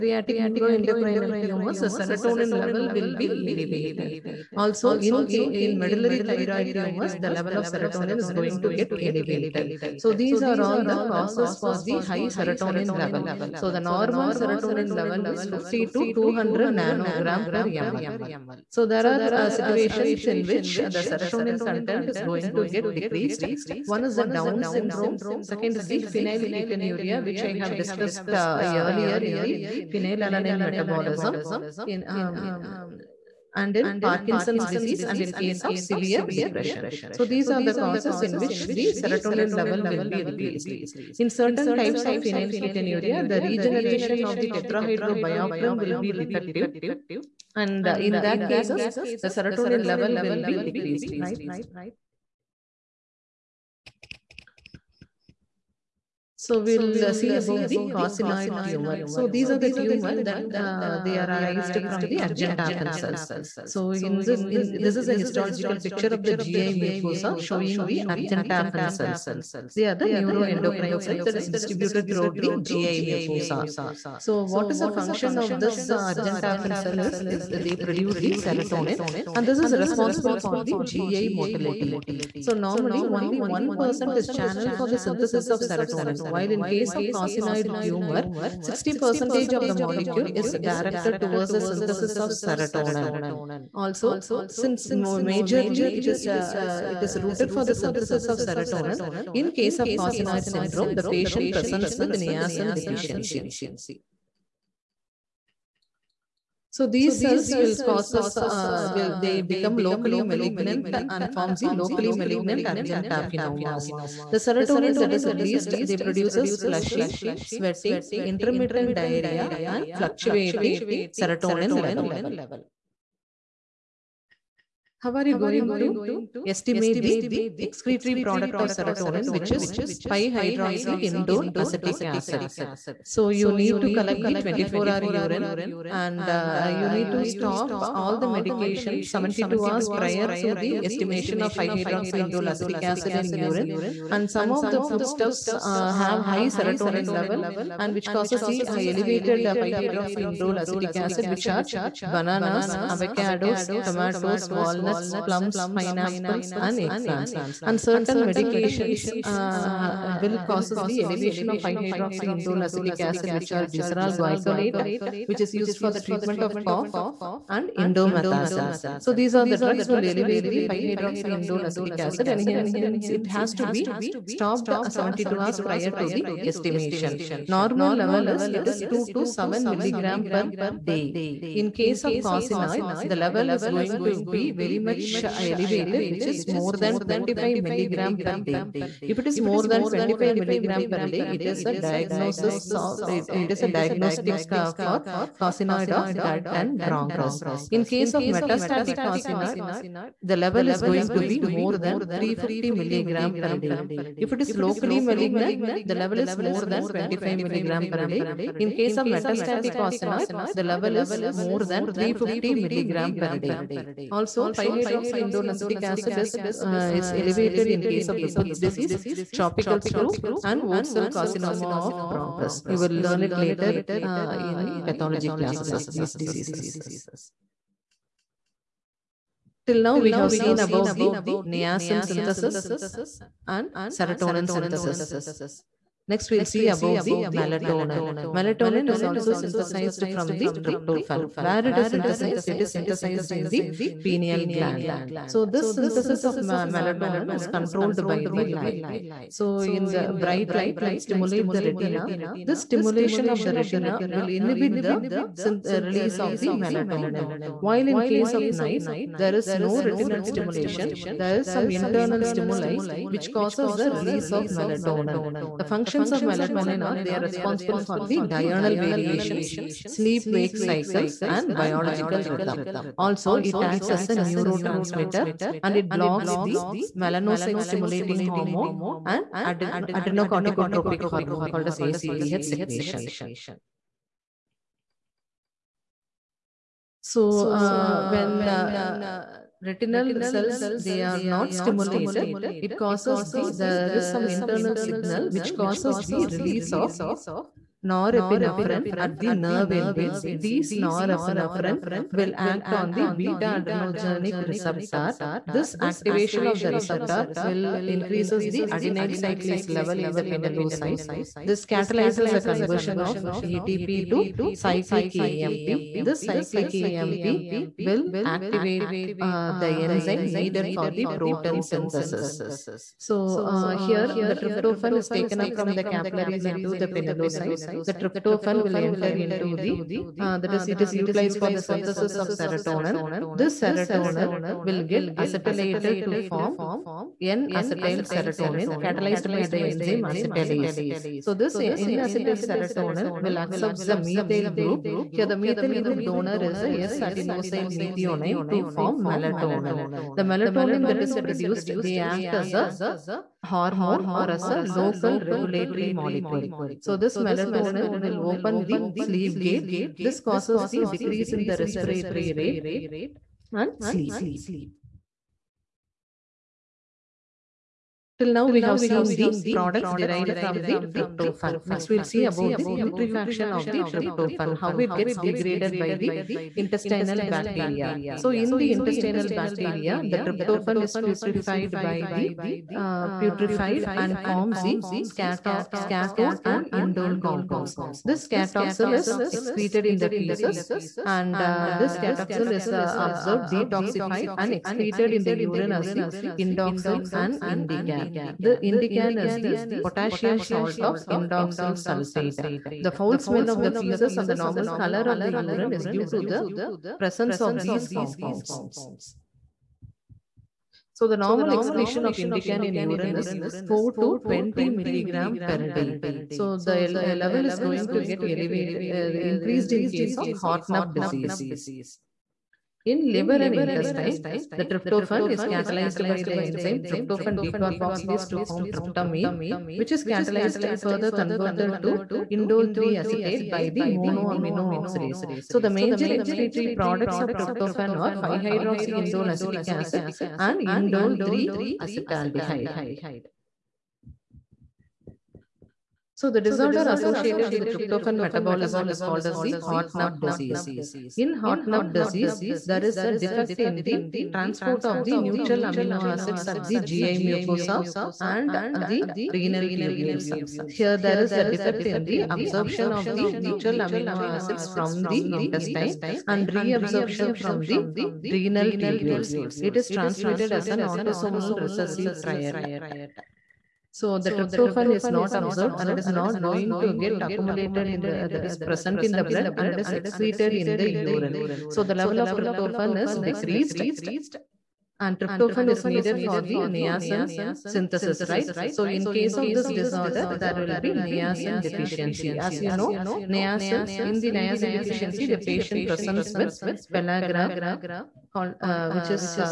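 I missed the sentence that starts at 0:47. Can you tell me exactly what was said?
And uh, in that cases, the serotonin level will be decreased, right?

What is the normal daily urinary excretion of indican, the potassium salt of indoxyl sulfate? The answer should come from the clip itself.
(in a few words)
4 to 20 mg/day.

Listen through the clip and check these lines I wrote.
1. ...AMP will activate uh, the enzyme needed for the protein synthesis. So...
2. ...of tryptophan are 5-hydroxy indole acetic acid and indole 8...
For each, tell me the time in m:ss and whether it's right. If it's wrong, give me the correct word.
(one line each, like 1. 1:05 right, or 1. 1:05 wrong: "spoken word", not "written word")
1. 5:16 right
2. 7:17 wrong: "3", not "8".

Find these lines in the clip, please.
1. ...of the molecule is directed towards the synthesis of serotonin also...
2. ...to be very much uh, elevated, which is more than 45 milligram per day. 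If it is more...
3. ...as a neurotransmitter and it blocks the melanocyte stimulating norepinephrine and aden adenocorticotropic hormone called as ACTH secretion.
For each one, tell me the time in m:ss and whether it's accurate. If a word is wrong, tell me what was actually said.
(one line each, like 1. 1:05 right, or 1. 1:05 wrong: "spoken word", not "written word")
1. 1:29 right
2. 3:04 wrong: "25", not "45"
3. 4:33 wrong: "hormone", not "norepinephrine".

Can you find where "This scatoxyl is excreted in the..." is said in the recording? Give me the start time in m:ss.
6:28.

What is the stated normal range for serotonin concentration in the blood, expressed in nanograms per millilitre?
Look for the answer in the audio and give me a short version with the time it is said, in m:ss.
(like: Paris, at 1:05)
50 to 200 ng/ml, at 0:15.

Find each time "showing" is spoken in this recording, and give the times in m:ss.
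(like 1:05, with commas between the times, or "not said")
1:07.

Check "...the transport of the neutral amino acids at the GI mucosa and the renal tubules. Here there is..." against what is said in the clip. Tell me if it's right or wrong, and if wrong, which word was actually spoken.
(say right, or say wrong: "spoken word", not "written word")
right.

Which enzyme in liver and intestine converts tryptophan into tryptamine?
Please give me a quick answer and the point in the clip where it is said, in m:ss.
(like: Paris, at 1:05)
Tryptophan decarboxylase, at 7:06.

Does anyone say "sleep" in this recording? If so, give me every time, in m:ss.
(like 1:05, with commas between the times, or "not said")
4:29, 5:58, 6:03.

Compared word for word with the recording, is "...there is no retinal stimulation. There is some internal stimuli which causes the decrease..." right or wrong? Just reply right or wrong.
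wrong.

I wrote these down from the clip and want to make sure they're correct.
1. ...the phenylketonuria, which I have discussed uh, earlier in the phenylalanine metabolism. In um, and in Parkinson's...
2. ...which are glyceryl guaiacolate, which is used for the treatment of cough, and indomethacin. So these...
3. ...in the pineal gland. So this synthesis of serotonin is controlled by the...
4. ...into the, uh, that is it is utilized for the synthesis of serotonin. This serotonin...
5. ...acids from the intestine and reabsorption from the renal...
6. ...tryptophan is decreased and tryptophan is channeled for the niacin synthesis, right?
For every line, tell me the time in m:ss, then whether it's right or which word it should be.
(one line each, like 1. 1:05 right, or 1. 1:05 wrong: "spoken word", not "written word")
1. 0:25 right
2. 2:43 right
3. 4:03 wrong: "melatonin", not "serotonin"
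4. 5:29 right
5. 7:44 right
6. 8:02 wrong: "needed", not "channeled".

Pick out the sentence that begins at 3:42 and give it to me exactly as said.
You will learn it later uh, in pathology classes, these diseases.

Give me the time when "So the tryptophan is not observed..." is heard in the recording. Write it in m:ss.
7:53.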